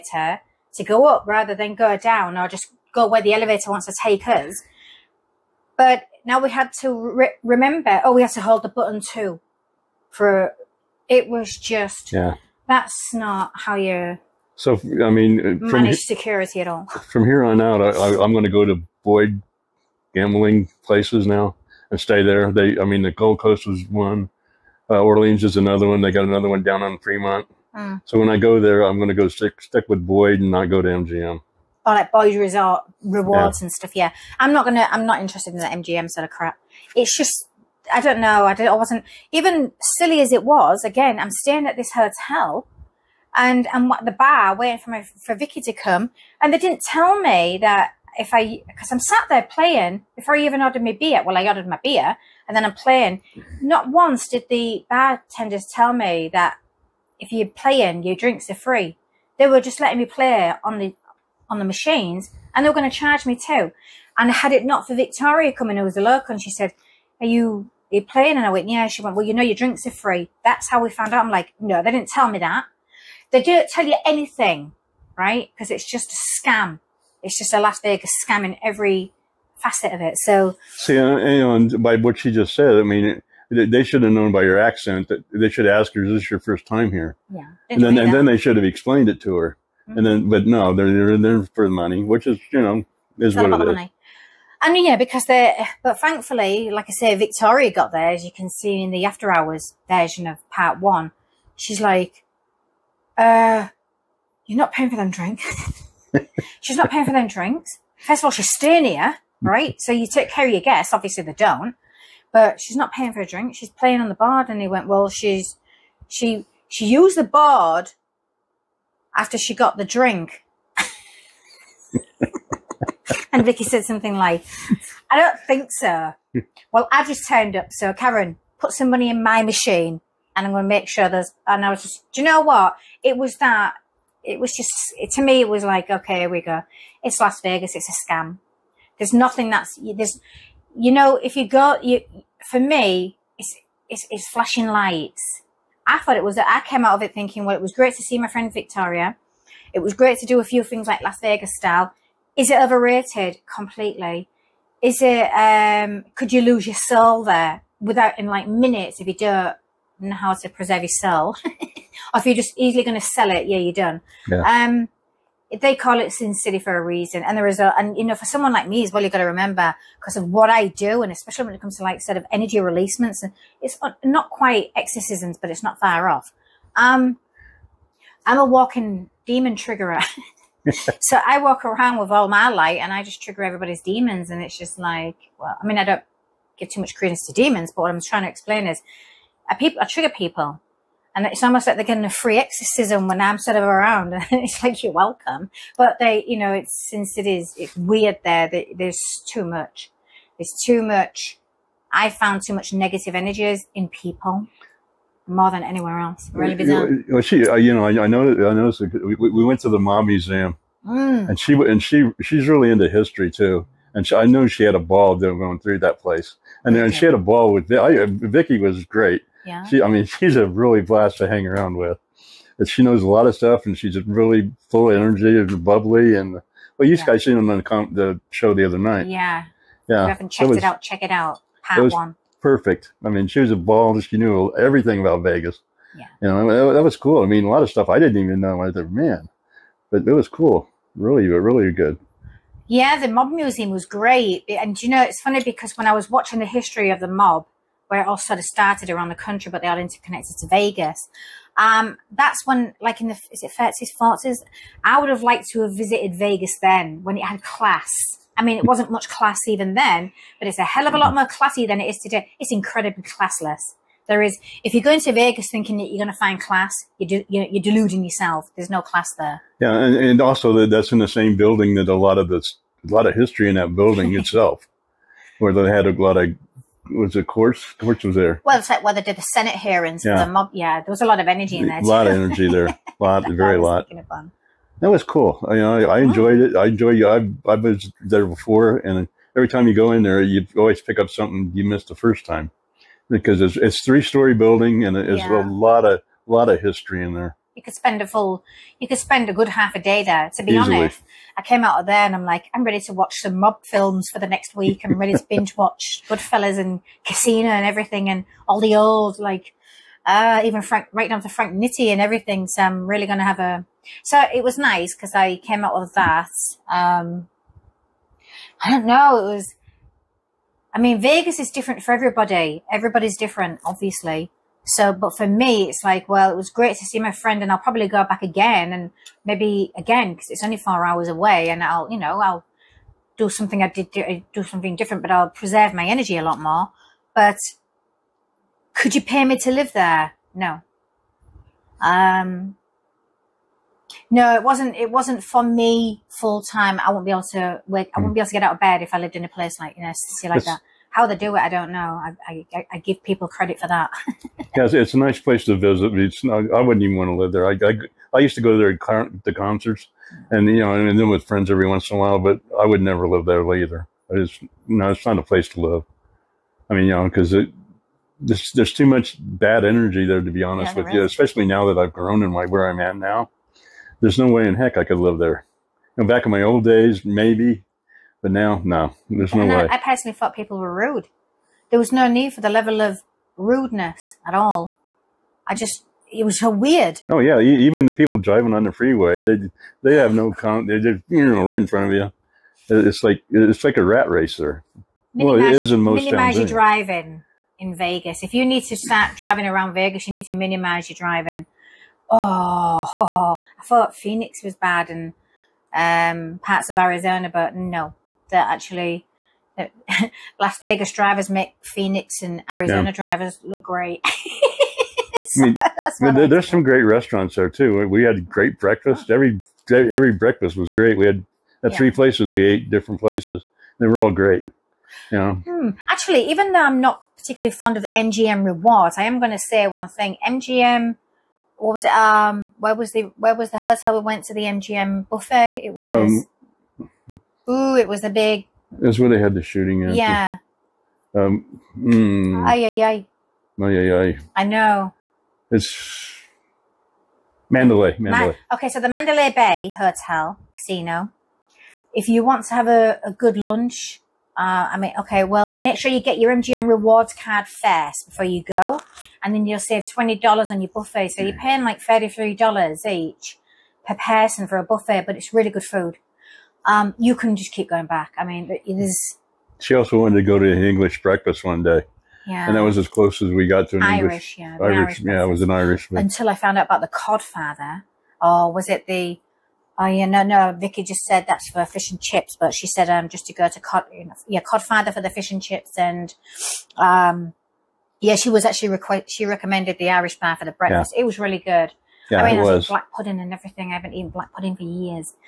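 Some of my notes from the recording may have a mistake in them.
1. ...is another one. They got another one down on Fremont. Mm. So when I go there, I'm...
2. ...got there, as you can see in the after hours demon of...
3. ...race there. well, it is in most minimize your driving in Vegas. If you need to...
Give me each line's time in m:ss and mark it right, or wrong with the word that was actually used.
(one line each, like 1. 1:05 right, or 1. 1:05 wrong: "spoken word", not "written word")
1. 0:25 right
2. 1:37 wrong: "version", not "demon"
3. 6:34 right.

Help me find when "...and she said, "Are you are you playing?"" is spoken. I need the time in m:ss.
1:06.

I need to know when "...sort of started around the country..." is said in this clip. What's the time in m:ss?
4:08.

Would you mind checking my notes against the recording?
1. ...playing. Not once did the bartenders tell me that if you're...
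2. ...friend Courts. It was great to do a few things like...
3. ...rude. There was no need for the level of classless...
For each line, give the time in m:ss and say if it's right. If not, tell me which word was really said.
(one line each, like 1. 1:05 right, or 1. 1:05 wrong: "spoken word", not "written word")
1. 0:52 right
2. 2:28 wrong: "Victoria", not "Courts"
3. 6:20 wrong: "rudeness", not "classless".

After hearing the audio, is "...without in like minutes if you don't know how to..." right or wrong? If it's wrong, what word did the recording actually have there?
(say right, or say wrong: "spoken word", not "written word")
right.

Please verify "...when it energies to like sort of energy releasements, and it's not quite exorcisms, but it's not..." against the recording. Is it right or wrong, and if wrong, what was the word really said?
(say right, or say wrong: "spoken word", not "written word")
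wrong: "comes", not "energies".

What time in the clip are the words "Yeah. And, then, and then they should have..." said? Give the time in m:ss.
1:27.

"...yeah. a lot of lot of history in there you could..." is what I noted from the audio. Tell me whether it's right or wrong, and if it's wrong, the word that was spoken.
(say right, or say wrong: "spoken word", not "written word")
right.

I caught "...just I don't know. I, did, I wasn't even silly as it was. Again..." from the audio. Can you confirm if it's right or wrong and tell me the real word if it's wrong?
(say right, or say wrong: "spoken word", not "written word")
right.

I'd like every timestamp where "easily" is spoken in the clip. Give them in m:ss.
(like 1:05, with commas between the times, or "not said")
2:42, 5:00.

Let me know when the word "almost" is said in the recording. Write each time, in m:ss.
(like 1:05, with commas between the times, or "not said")
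3:11.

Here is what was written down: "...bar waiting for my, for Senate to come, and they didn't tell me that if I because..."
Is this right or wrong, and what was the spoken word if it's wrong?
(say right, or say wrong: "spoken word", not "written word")
wrong: "Vicky", not "Senate".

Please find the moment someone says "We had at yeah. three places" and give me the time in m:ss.
7:00.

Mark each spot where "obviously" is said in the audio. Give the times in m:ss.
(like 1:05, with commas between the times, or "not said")
1:50, 5:23.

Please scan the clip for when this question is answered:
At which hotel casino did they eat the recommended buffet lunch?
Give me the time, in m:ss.
7:28.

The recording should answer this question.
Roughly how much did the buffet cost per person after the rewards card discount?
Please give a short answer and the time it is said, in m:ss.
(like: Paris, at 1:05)
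$33, at 7:41.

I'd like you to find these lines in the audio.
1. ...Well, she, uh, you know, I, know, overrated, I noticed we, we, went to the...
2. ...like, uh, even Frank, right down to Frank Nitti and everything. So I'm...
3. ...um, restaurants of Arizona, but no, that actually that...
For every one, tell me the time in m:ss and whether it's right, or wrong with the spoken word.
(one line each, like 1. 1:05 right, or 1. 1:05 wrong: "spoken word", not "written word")
1. 3:27 wrong: "noticed", not "overrated"
2. 5:09 right
3. 6:45 wrong: "parts", not "restaurants".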